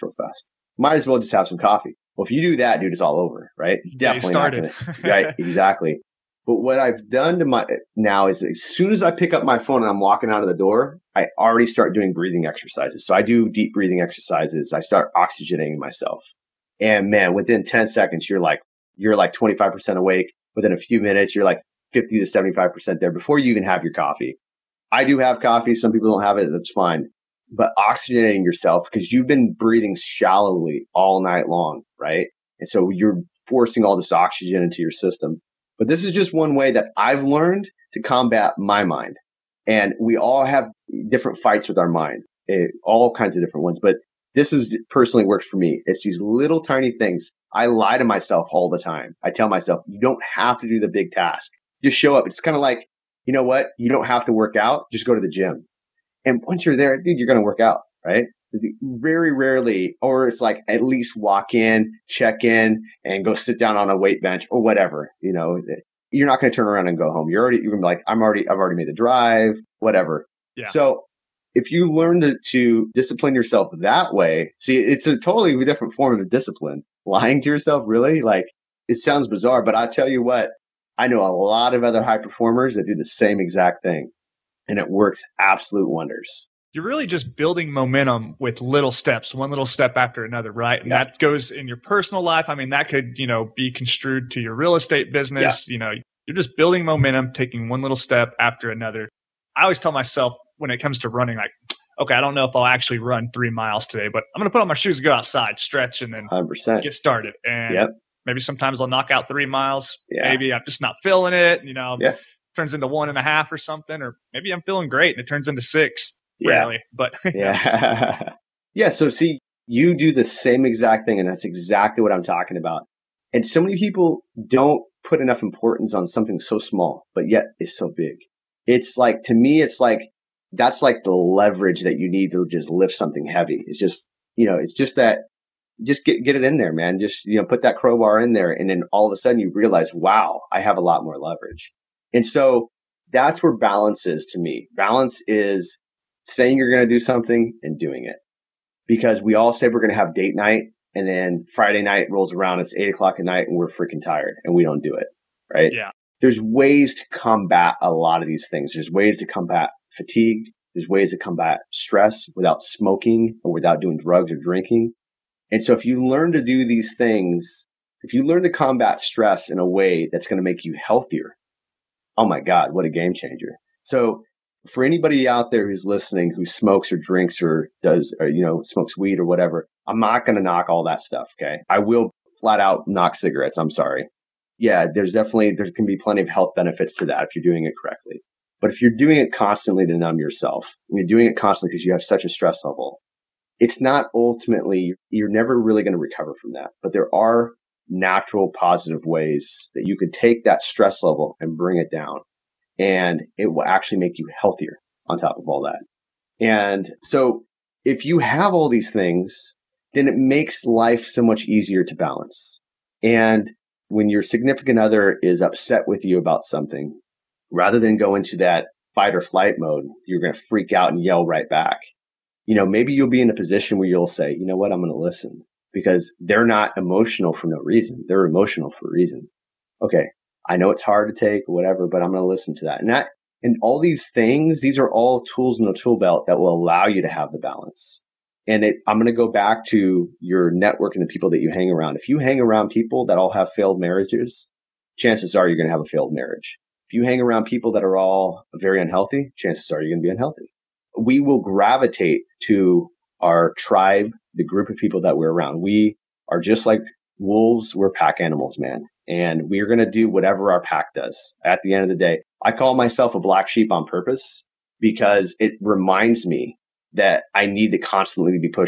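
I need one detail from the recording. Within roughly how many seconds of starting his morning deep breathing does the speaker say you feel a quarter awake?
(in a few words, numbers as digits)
10 seconds.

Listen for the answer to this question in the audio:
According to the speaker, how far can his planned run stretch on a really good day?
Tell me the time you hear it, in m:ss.
1:55.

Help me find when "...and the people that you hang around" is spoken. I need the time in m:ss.
4:00.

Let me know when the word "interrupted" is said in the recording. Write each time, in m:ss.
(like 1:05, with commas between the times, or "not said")
not said.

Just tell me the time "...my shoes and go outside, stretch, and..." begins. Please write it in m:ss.
1:44.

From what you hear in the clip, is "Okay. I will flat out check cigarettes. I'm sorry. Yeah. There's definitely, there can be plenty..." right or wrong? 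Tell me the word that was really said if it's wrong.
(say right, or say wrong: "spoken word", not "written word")
wrong: "knock", not "check".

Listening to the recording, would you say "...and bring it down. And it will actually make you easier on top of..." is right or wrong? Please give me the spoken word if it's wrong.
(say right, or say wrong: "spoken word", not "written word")
wrong: "healthier", not "easier".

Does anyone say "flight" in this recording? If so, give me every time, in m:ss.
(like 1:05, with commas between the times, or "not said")
3:39.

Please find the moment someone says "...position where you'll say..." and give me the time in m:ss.
3:43.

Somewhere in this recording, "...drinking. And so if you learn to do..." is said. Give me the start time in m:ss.
2:44.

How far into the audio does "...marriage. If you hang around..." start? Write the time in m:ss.
4:06.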